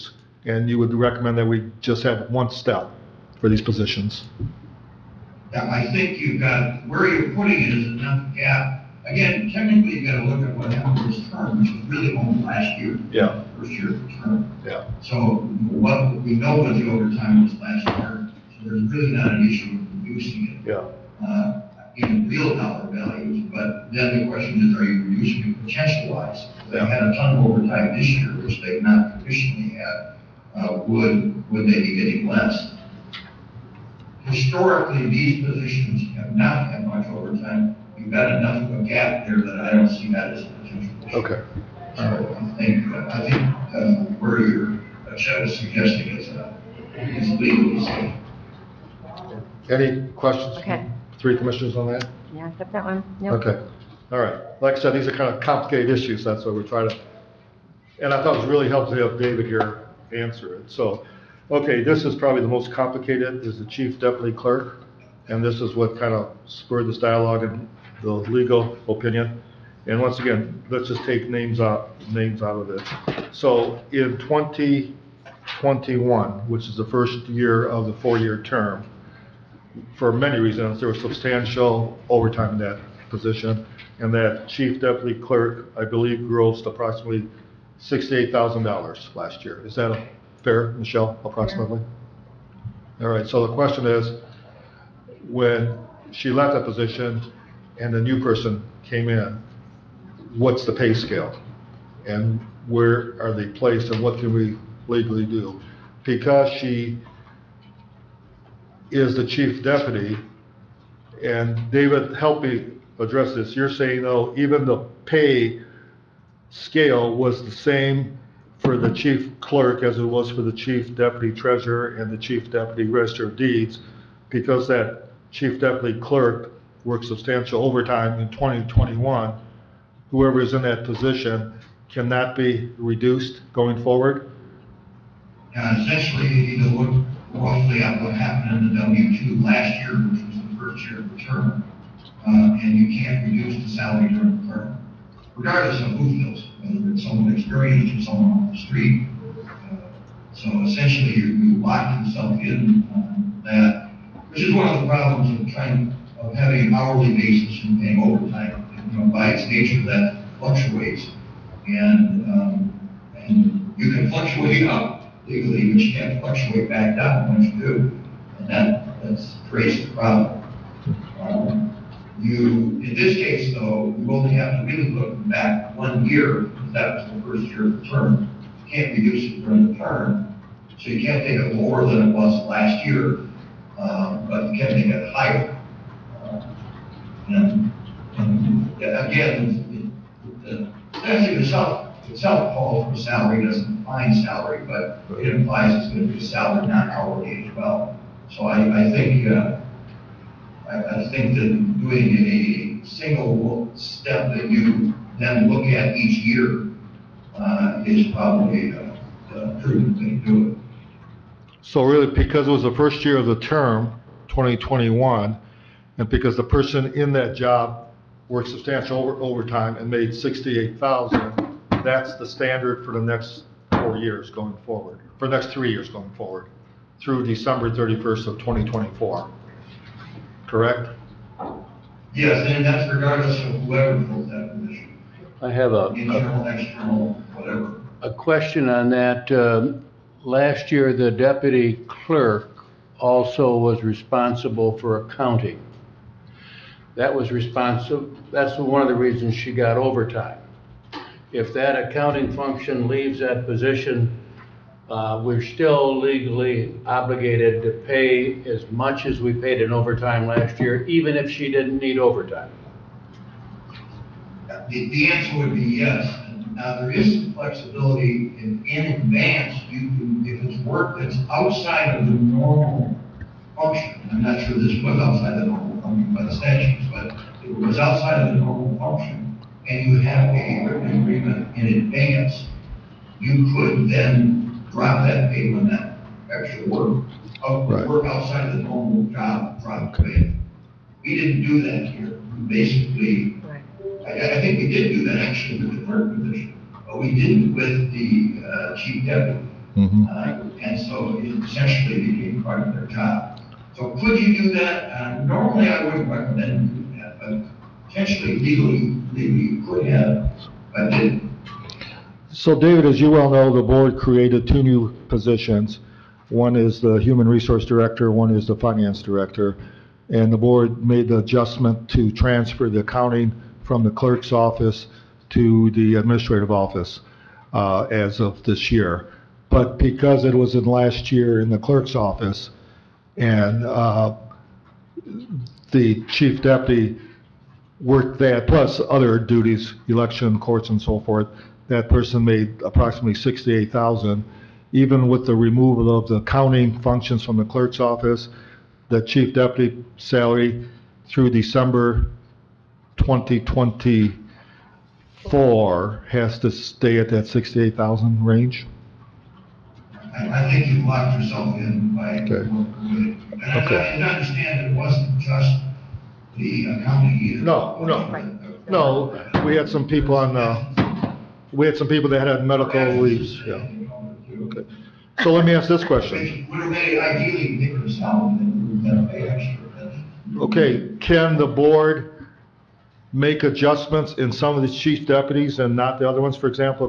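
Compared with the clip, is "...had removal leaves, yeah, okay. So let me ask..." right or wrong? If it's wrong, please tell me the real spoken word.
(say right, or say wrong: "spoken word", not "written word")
wrong: "medical", not "removal".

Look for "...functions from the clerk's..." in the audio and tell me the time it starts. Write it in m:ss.
5:46.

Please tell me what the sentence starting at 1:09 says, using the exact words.
And once again, let's just take names out, names out of this.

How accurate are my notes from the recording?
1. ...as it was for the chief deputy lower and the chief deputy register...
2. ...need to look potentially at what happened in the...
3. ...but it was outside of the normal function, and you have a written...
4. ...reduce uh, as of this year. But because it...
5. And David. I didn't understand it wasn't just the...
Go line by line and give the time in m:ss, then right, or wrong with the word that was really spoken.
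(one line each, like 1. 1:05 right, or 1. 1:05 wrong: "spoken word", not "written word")
1. 1:59 wrong: "treasurer", not "lower"
2. 2:16 wrong: "roughly", not "potentially"
3. 4:36 right
4. 5:26 wrong: "office", not "reduce"
5. 6:02 wrong: "Okay", not "David".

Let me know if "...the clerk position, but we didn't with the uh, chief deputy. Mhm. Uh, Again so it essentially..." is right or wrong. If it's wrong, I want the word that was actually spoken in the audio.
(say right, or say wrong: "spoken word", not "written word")
wrong: "And", not "Again".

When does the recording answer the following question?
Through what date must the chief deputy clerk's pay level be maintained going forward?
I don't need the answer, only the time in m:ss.
3:47.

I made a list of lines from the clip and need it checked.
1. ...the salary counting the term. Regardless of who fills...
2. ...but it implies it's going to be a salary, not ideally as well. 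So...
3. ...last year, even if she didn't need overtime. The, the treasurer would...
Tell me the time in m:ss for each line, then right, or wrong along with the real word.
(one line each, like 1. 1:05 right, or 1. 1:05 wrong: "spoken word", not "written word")
1. 2:23 wrong: "during", not "counting"
2. 3:14 wrong: "hourly", not "ideally"
3. 4:20 wrong: "answer", not "treasurer".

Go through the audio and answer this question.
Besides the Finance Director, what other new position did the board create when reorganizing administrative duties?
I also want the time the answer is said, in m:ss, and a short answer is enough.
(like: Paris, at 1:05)
Human Resource Director, at 5:16.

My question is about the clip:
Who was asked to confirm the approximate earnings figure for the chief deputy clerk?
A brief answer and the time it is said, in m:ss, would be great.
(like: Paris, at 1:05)
Michelle, at 1:30.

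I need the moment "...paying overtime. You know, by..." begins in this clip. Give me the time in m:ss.
2:37.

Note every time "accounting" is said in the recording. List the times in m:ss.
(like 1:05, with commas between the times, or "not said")
4:05, 4:11, 5:22, 6:06.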